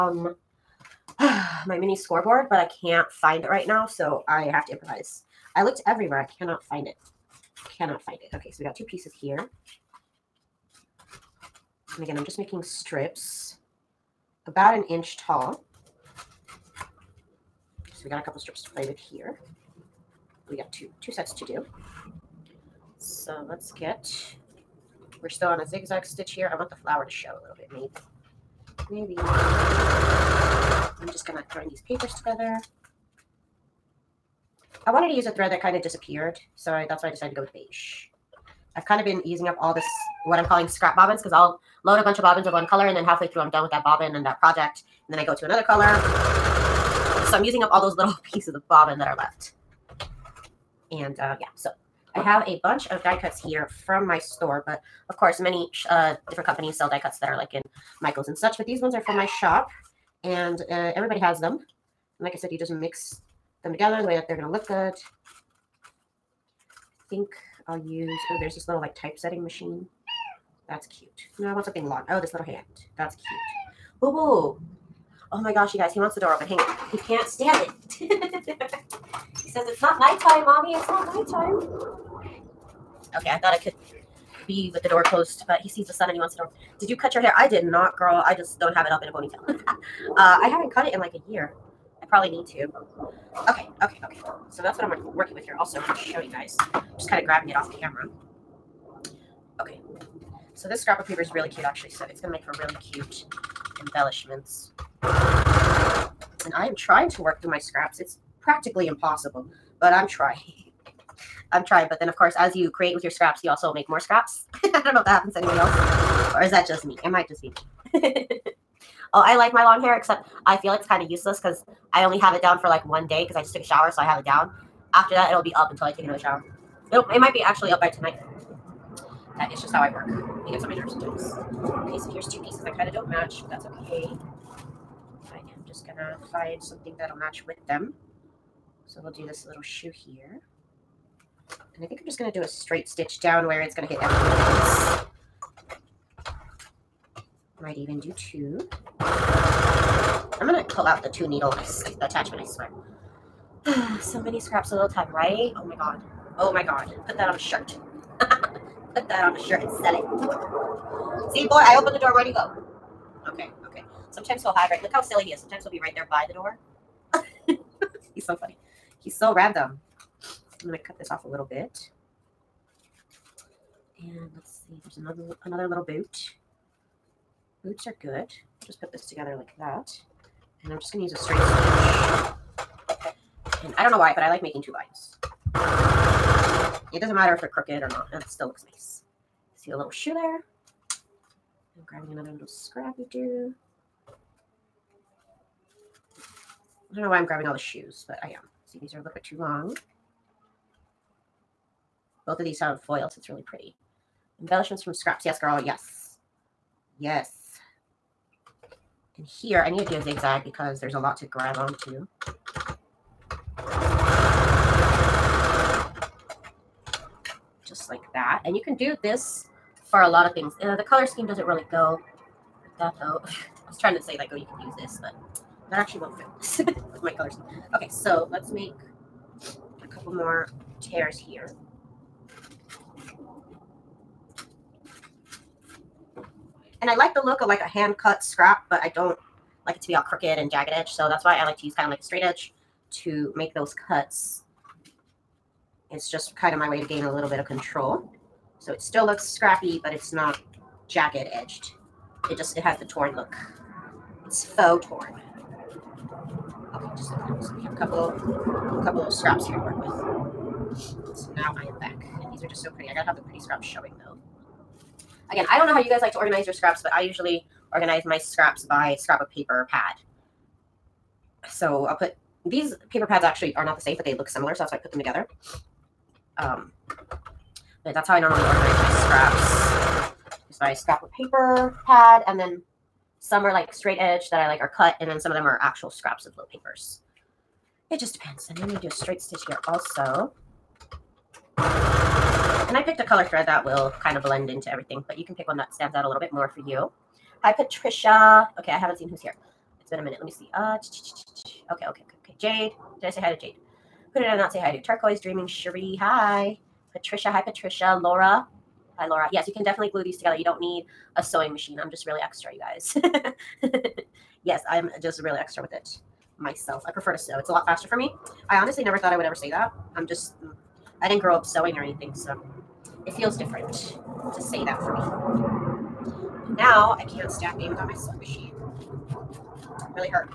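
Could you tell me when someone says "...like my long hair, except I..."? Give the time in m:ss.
1:59.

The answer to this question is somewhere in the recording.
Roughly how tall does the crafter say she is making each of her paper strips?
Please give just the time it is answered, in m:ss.
0:14.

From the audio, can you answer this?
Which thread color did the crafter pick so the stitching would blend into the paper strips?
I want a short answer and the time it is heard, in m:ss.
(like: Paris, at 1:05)
beige, at 0:37.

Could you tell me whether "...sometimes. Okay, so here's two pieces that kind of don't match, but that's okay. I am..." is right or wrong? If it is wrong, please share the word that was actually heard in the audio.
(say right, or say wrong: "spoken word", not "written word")
right.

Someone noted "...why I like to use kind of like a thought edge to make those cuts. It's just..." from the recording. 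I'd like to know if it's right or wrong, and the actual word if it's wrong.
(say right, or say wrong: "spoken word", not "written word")
wrong: "straight", not "thought".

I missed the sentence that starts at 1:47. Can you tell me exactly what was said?
It's practically impossible, but I'm trying.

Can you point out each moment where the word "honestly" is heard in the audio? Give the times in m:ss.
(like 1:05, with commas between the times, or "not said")
5:18.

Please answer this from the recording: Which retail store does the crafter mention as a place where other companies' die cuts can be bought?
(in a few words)
Michaels.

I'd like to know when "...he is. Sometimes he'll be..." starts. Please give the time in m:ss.
2:45.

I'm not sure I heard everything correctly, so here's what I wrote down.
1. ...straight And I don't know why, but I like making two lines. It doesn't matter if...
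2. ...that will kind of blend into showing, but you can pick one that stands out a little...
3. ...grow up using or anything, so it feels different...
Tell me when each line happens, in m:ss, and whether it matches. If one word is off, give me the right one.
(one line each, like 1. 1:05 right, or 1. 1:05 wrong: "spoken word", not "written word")
1. 3:01 right
2. 4:53 wrong: "everything", not "showing"
3. 5:21 wrong: "sewing", not "using".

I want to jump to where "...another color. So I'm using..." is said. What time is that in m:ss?
0:45.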